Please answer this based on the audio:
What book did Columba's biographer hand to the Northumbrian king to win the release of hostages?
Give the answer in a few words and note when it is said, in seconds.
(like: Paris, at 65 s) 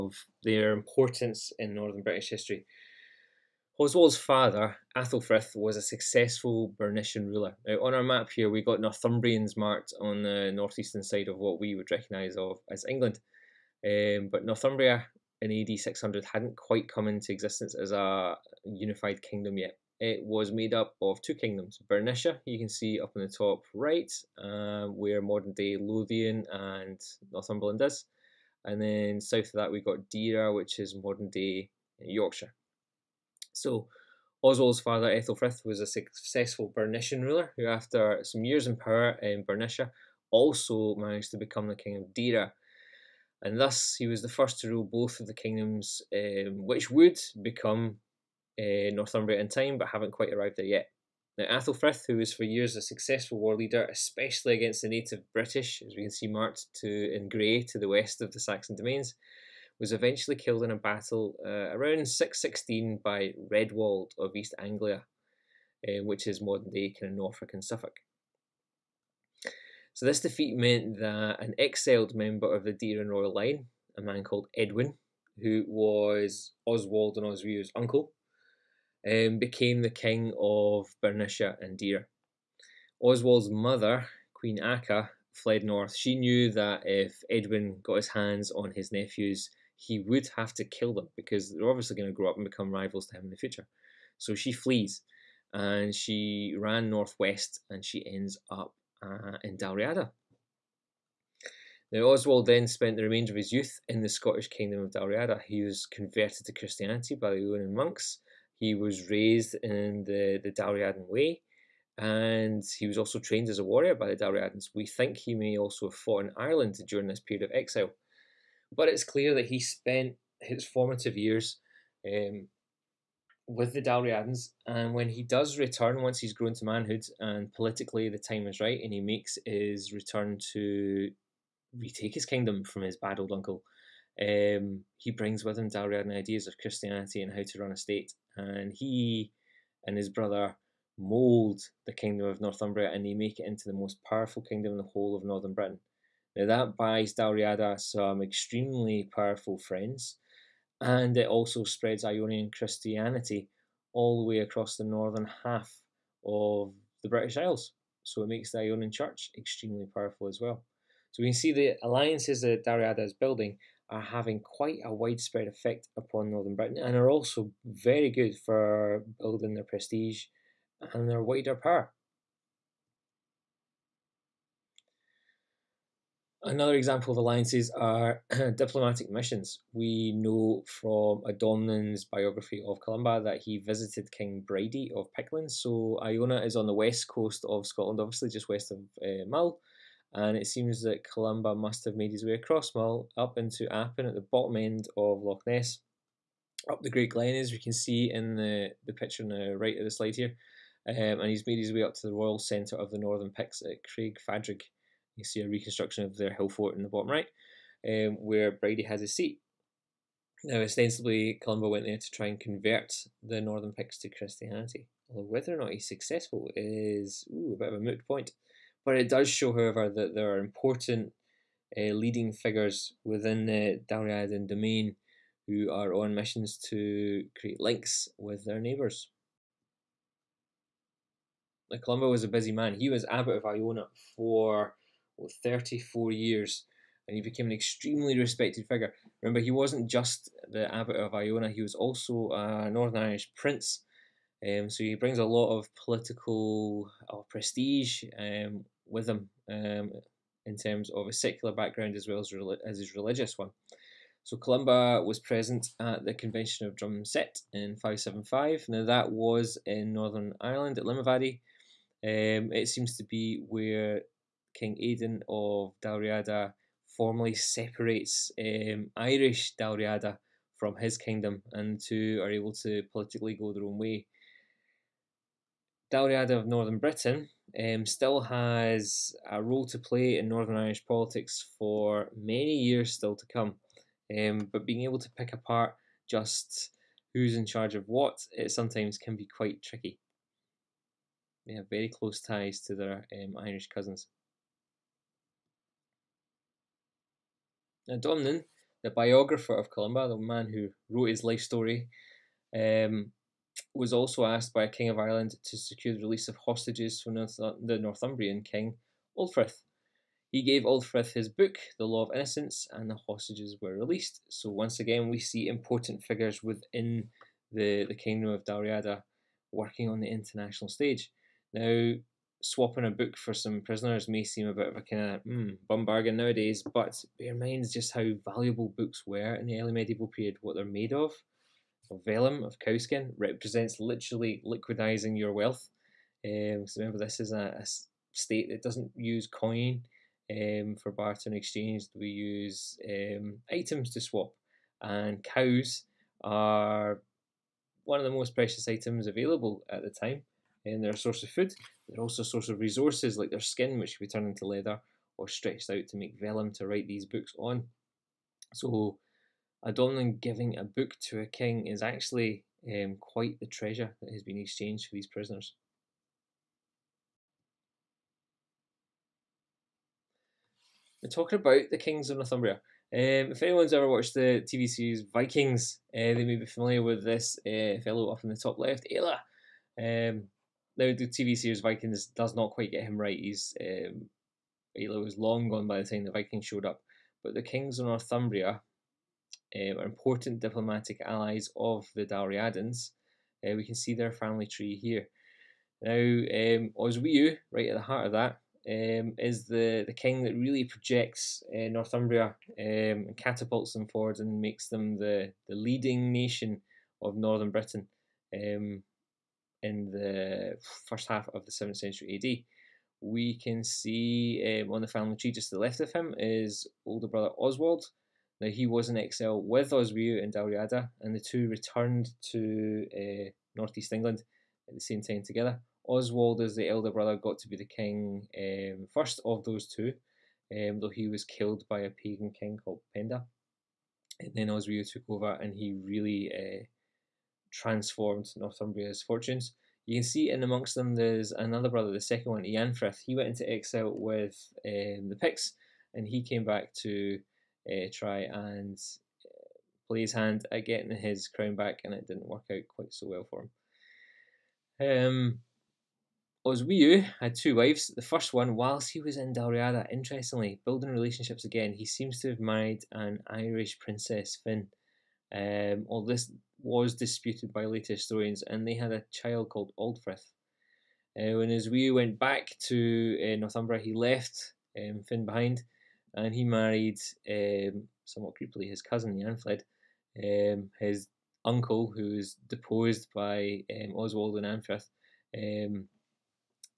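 The Law of Innocence, at 311 s.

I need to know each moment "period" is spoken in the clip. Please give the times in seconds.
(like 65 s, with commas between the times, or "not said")
117 s, 330 s.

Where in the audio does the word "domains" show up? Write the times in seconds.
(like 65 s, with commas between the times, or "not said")
58 s, 224 s.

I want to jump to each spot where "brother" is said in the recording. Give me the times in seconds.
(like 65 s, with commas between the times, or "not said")
140 s, 417 s, 426 s, 441 s.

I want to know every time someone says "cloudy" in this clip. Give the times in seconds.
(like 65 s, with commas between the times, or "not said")
not said.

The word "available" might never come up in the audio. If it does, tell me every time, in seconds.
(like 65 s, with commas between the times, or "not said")
349 s.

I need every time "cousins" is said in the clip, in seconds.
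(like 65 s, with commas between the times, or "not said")
293 s, 478 s.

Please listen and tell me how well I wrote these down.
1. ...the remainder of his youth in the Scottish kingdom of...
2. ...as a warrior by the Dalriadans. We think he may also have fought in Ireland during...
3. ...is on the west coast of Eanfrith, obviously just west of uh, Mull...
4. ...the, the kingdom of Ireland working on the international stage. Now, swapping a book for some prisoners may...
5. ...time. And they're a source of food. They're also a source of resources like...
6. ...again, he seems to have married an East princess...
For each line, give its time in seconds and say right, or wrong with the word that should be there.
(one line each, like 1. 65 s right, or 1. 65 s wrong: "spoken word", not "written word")
1. 102 s right
2. 113 s right
3. 186 s wrong: "Scotland", not "Eanfrith"
4. 317 s wrong: "Dalriada", not "Ireland"
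5. 349 s right
6. 461 s wrong: "Irish", not "East".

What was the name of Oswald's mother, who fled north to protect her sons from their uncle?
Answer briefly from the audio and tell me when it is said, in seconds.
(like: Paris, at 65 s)
Akka, at 84 s.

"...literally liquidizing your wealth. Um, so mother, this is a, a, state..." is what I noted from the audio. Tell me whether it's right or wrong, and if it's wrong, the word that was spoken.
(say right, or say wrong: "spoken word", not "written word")
wrong: "remember", not "mother".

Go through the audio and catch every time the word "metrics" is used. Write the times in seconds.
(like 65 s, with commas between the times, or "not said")
not said.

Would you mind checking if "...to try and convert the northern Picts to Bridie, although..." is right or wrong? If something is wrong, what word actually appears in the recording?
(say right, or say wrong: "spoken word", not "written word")
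wrong: "Christianity", not "Bridie".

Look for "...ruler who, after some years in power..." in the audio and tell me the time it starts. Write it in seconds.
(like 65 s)
37 s.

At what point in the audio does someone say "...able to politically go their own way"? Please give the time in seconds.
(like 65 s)
272 s.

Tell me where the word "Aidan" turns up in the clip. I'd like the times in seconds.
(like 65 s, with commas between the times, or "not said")
264 s.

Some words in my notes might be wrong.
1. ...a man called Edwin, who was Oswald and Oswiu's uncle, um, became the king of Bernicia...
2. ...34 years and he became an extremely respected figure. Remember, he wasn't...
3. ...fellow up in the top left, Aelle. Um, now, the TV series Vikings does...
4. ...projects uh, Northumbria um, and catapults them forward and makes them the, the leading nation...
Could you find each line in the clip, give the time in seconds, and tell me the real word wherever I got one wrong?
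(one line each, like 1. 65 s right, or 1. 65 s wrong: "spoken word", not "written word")
1. 73 s right
2. 235 s right
3. 377 s right
4. 400 s right.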